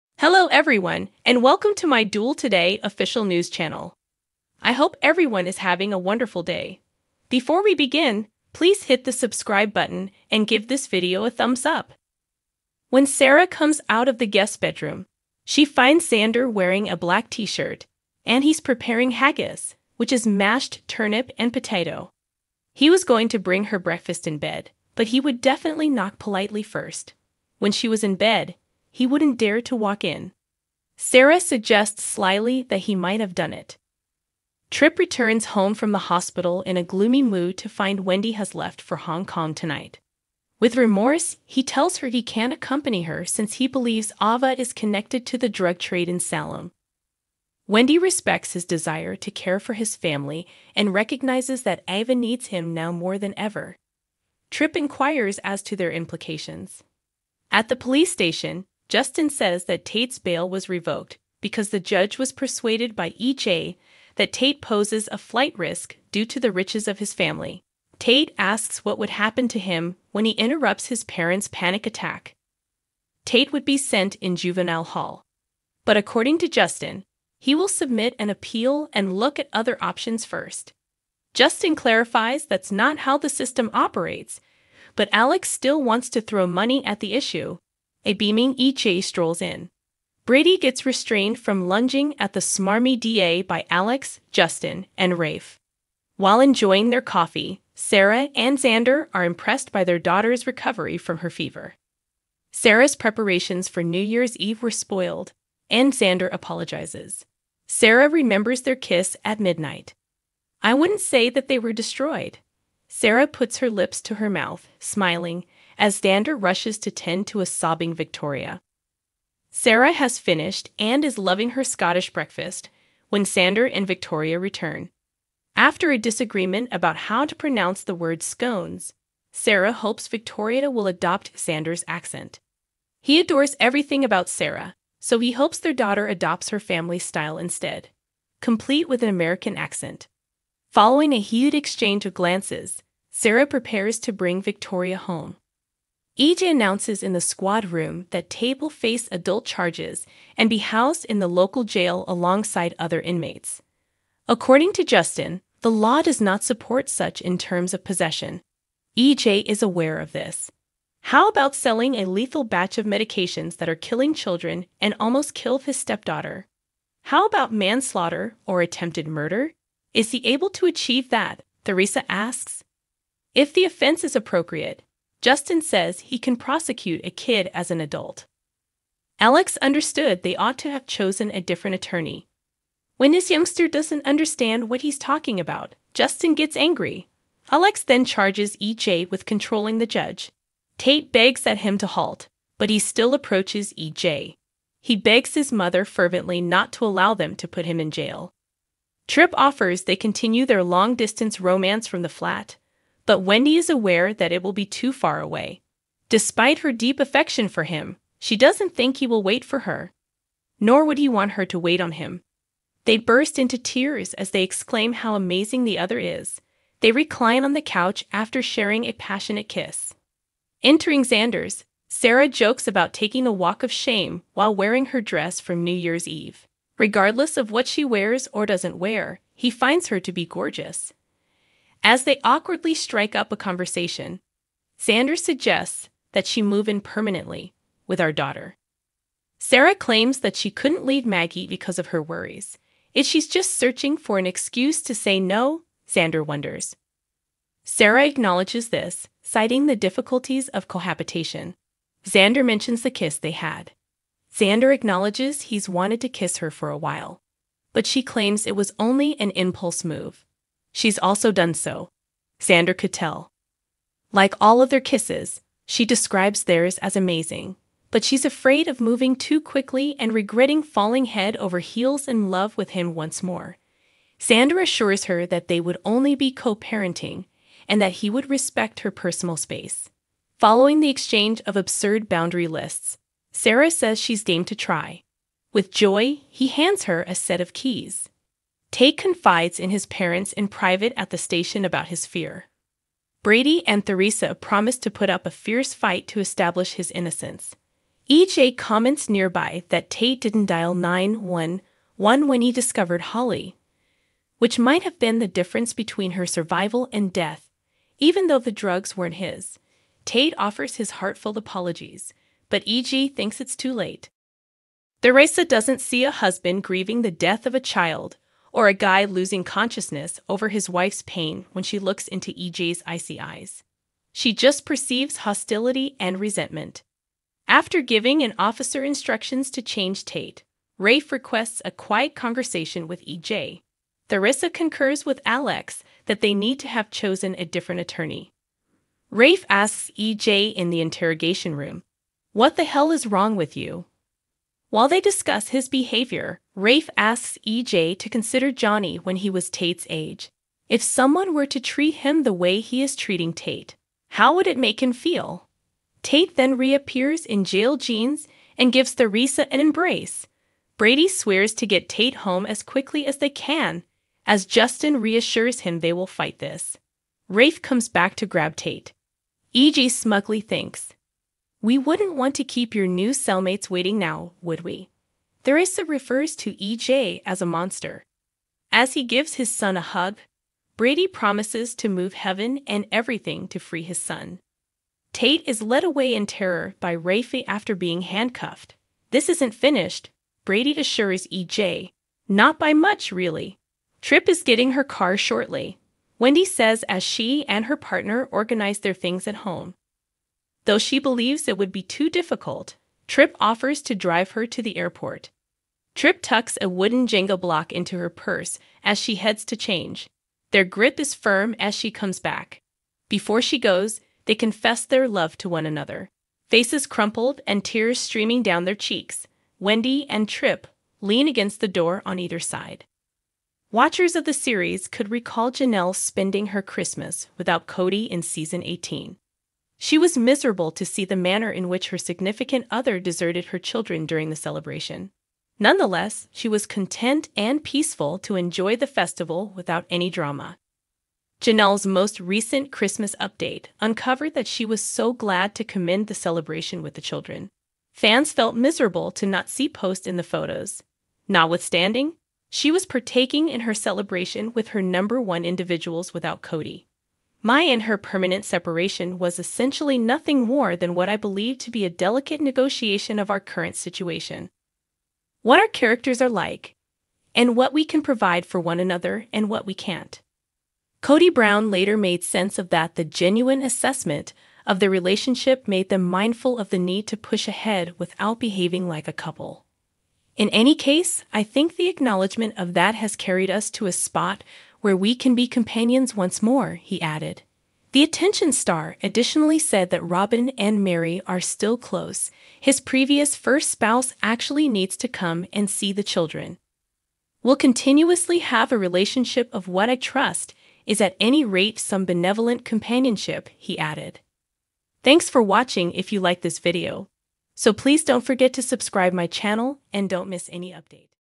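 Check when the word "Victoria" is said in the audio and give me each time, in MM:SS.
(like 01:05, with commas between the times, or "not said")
01:57, 02:03, 02:10, 02:24.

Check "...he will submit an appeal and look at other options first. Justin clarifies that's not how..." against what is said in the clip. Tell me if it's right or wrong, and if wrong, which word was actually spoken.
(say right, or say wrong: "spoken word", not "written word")
right.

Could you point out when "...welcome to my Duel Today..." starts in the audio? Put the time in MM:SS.
00:01.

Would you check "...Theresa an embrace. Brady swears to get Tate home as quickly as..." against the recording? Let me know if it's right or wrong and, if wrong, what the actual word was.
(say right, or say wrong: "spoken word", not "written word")
right.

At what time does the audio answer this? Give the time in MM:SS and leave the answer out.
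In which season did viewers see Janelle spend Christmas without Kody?
07:08.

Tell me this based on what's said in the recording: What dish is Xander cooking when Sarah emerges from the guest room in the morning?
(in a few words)
haggis.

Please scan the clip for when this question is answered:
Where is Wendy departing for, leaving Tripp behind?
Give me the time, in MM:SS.
00:38.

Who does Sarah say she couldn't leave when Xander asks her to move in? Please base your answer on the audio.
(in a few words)
Maggie.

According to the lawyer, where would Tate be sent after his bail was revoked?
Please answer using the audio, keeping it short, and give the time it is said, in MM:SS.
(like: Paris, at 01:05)
juvenile hall, at 01:14.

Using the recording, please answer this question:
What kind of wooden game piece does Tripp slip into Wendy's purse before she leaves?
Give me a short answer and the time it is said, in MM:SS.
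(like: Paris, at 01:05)
Jenga block, at 06:47.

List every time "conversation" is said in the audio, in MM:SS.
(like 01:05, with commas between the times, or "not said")
03:53, 05:32.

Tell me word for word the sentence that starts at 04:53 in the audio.
Brady and Theresa promise to put up a fierce fight to establish his innocence.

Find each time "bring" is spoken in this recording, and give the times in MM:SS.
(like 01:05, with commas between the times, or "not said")
00:23, 02:24.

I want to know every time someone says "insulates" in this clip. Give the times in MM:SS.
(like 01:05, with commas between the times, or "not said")
not said.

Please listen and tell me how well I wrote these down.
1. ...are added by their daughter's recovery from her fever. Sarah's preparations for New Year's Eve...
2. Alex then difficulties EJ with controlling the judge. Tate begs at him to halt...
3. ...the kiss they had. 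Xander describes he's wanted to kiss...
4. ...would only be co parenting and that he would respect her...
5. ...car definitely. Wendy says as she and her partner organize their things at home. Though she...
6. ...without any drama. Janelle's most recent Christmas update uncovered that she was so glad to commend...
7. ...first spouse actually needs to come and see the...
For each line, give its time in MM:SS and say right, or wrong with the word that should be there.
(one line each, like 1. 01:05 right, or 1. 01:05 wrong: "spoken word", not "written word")
1. 01:39 wrong: "impressed", not "added"
2. 03:07 wrong: "charges", not "difficulties"
3. 04:12 wrong: "acknowledges", not "describes"
4. 04:35 right
5. 06:34 wrong: "shortly", not "definitely"
6. 07:19 right
7. 08:13 right.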